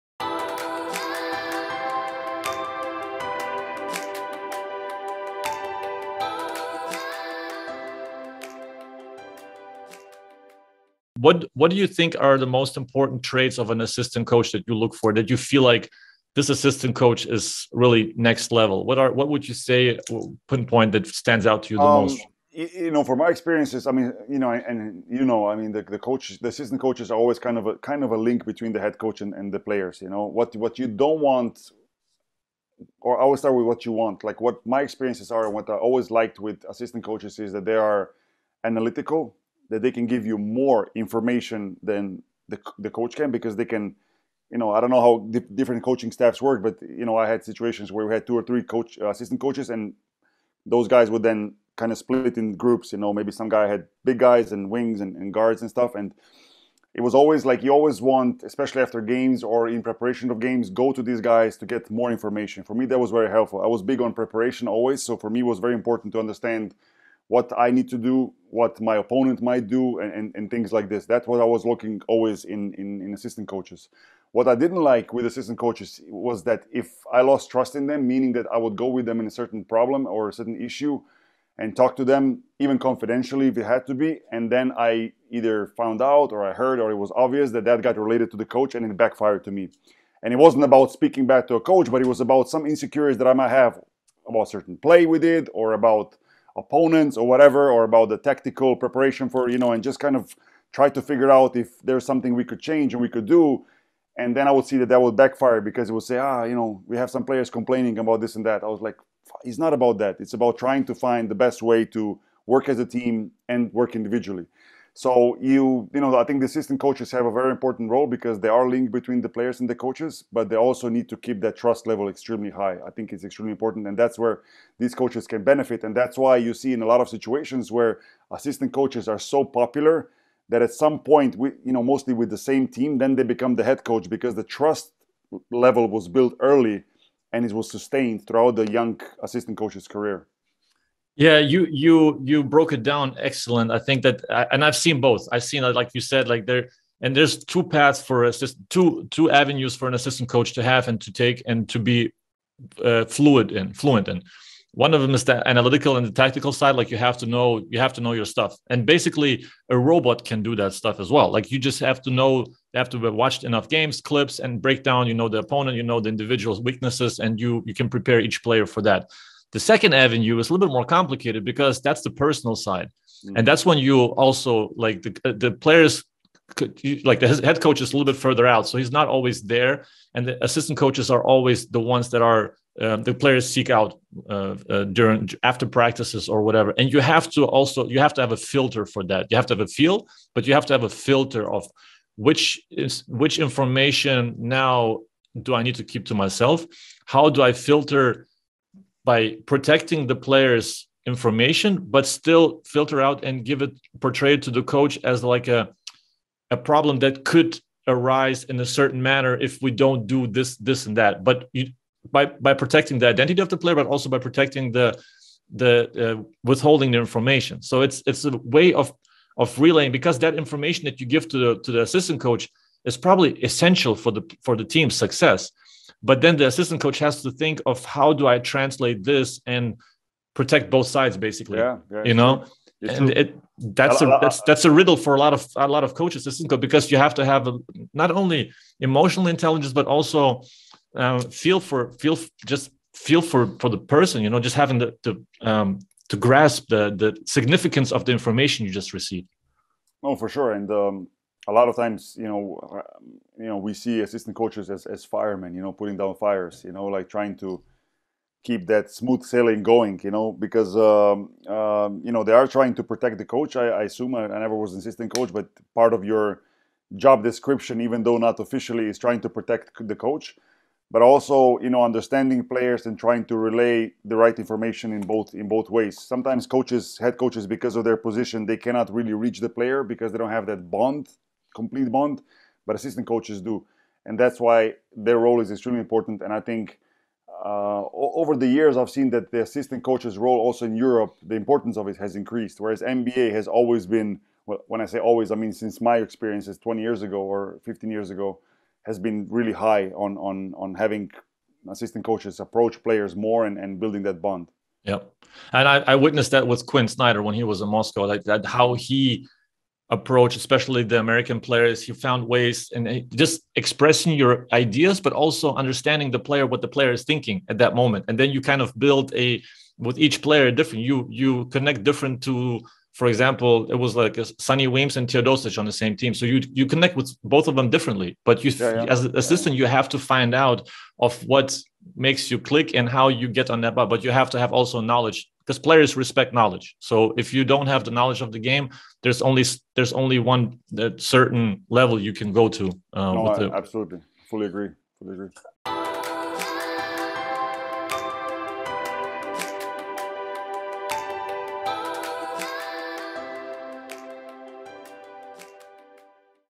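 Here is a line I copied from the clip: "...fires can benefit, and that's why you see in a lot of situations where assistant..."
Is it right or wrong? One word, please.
wrong.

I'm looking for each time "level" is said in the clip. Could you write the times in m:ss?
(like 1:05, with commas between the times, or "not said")
0:18, 2:01, 2:15, 5:41.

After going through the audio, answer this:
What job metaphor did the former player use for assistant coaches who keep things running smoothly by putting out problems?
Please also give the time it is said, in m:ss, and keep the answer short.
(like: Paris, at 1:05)
firemen, at 4:15.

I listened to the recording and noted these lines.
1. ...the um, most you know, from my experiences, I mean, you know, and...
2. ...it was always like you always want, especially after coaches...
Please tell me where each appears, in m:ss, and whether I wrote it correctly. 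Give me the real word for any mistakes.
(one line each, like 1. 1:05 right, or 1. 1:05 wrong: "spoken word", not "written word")
1. 0:21 right
2. 0:56 wrong: "games", not "coaches".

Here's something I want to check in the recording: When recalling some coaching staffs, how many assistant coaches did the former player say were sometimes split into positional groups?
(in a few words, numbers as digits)
two or three.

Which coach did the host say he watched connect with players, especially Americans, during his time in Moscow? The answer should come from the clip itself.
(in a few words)
Quinn Snyder.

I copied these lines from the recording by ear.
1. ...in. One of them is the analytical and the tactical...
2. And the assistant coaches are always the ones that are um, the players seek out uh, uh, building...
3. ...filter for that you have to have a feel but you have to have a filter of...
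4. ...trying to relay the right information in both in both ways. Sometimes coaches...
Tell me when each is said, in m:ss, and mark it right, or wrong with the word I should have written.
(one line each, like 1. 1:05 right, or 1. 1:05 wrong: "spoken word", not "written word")
1. 2:34 right
2. 3:00 wrong: "during", not "building"
3. 3:08 right
4. 4:32 right.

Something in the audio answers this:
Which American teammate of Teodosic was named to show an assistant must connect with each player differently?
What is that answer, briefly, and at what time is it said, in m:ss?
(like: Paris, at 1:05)
Sonny Weems, at 5:24.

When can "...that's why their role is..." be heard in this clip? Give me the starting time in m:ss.
4:44.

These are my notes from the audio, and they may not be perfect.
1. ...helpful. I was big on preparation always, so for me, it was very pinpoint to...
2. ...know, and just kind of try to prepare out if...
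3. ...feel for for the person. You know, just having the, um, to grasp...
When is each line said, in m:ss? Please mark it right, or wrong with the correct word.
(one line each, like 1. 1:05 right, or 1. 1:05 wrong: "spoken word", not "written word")
1. 1:03 wrong: "important", not "pinpoint"
2. 1:39 wrong: "figure", not "prepare"
3. 4:02 right.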